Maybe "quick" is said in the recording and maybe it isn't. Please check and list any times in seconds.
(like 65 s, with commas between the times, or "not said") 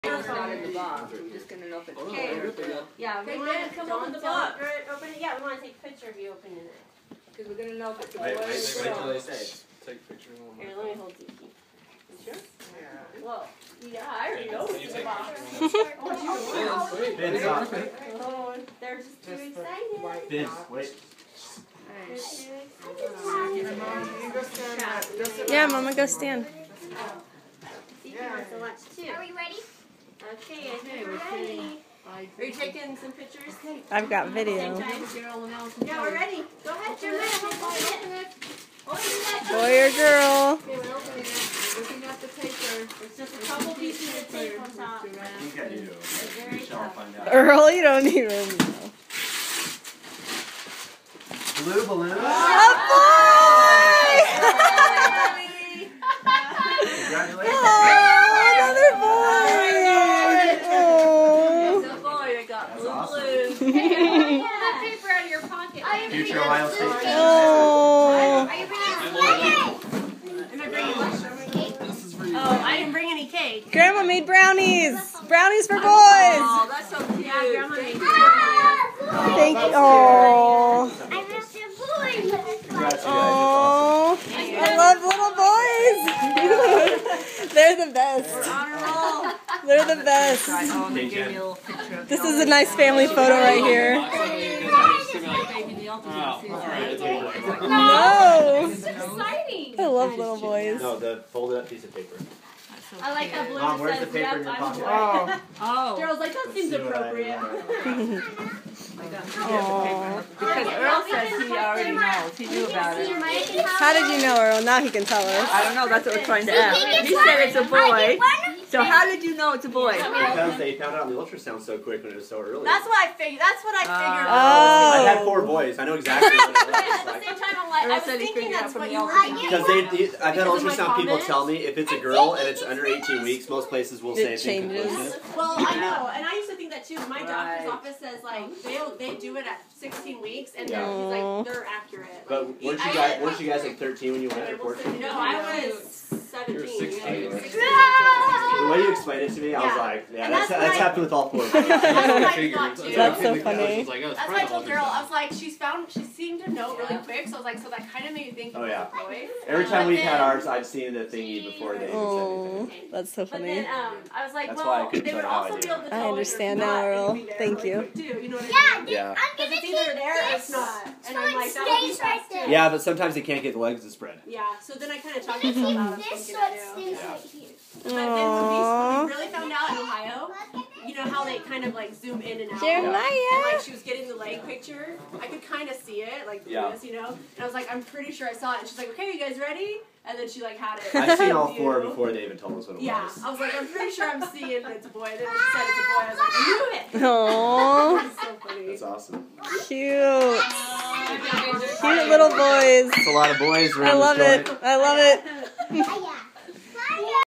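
121 s, 156 s.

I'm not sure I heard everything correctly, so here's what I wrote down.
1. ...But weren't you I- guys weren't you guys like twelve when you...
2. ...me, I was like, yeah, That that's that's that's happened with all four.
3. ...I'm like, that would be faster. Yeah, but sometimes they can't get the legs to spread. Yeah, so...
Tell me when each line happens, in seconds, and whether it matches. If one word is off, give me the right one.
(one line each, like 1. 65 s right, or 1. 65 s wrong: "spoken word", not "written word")
1. 142 s wrong: "thirteen", not "twelve"
2. 149 s wrong: "And", not "That"
3. 171 s right.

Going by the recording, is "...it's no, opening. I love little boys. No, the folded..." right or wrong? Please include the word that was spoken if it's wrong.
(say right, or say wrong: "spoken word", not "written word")
wrong: "exciting", not "opening".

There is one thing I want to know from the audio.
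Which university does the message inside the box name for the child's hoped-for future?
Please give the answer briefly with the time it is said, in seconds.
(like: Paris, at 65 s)
Ohio State, at 66 s.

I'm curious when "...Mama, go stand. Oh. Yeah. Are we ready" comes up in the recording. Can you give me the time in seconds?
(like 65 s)
25 s.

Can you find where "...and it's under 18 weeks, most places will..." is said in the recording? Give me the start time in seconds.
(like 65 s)
132 s.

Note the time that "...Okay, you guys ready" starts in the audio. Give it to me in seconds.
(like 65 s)
188 s.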